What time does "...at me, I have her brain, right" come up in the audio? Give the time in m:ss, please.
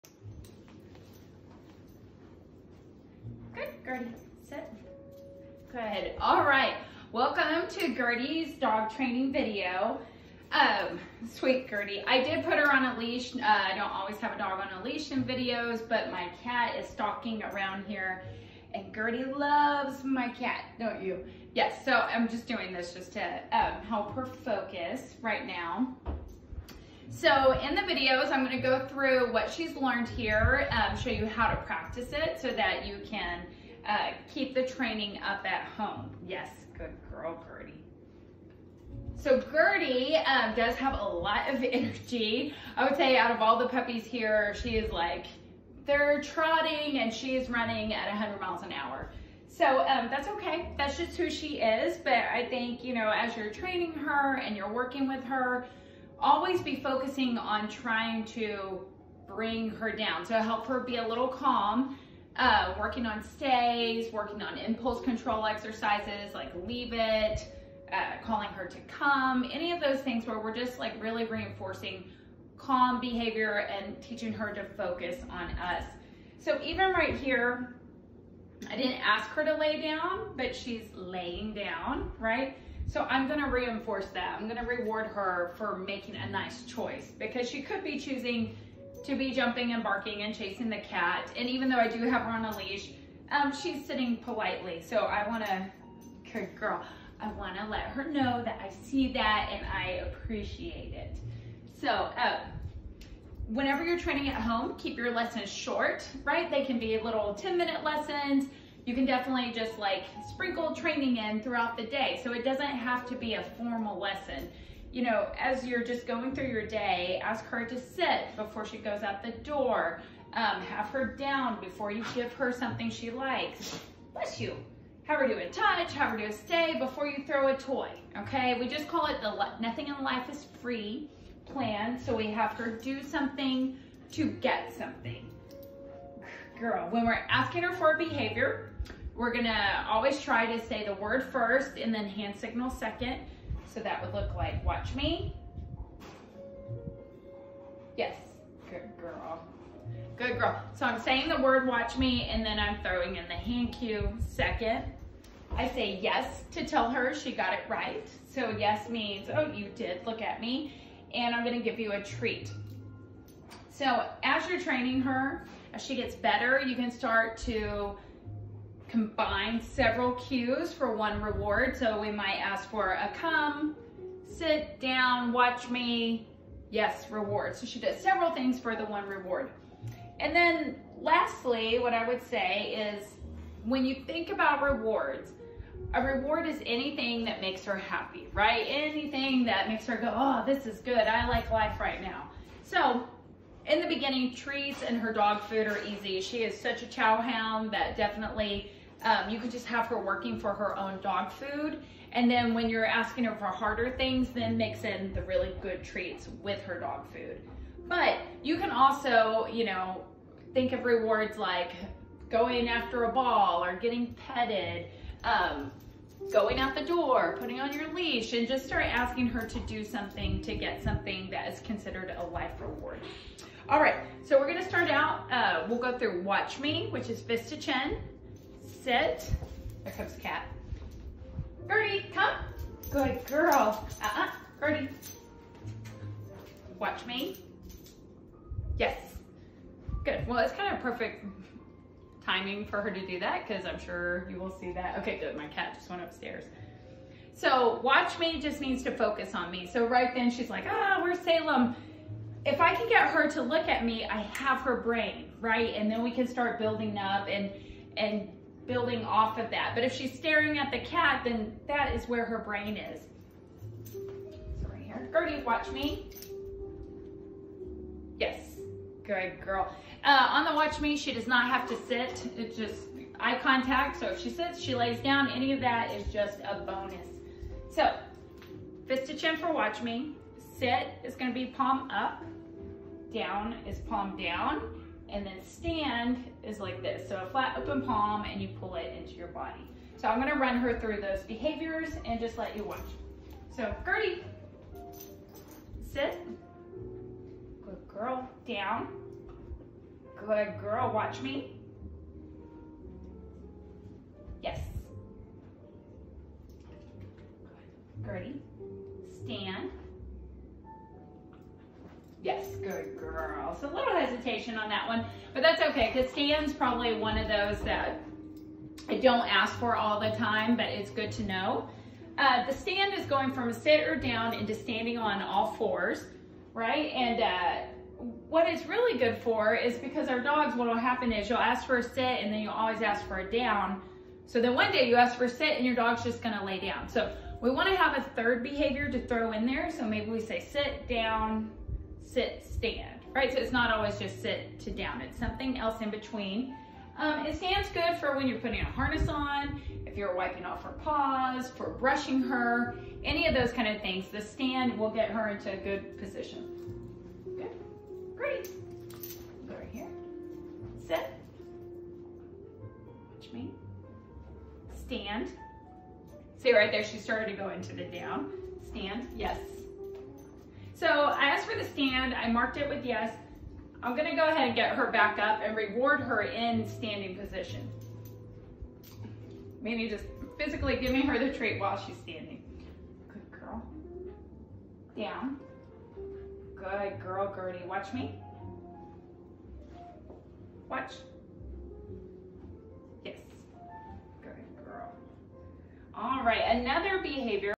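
4:13.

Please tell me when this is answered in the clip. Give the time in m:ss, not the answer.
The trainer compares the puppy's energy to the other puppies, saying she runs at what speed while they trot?
0:48.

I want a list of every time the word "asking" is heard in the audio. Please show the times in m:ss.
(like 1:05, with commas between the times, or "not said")
2:17, 3:22, 3:38.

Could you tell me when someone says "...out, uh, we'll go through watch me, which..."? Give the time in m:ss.
3:44.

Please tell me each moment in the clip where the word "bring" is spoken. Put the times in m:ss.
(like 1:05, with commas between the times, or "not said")
0:59.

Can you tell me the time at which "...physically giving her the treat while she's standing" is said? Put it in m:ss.
6:20.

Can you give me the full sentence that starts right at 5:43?
So it's not always just sit to down.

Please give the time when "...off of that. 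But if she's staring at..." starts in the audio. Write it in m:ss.
4:19.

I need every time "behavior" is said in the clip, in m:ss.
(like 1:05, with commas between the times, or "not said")
1:13, 2:17, 4:51, 5:38, 6:37.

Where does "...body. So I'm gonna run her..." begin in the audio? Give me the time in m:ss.
4:49.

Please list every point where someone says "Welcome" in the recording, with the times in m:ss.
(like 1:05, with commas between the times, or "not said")
0:07.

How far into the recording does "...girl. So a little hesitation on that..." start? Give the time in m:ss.
5:12.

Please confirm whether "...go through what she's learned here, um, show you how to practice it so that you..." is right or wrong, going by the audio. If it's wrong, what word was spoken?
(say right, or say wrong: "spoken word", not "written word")
right.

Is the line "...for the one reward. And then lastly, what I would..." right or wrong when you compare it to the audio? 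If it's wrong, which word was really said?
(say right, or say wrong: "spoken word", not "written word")
right.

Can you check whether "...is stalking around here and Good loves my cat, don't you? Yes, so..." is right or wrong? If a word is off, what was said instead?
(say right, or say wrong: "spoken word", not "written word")
wrong: "Gertie", not "Good".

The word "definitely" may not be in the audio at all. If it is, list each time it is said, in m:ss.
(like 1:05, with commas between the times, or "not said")
1:49, 3:17.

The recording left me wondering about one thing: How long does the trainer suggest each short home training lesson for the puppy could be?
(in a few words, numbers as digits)
10 minutes.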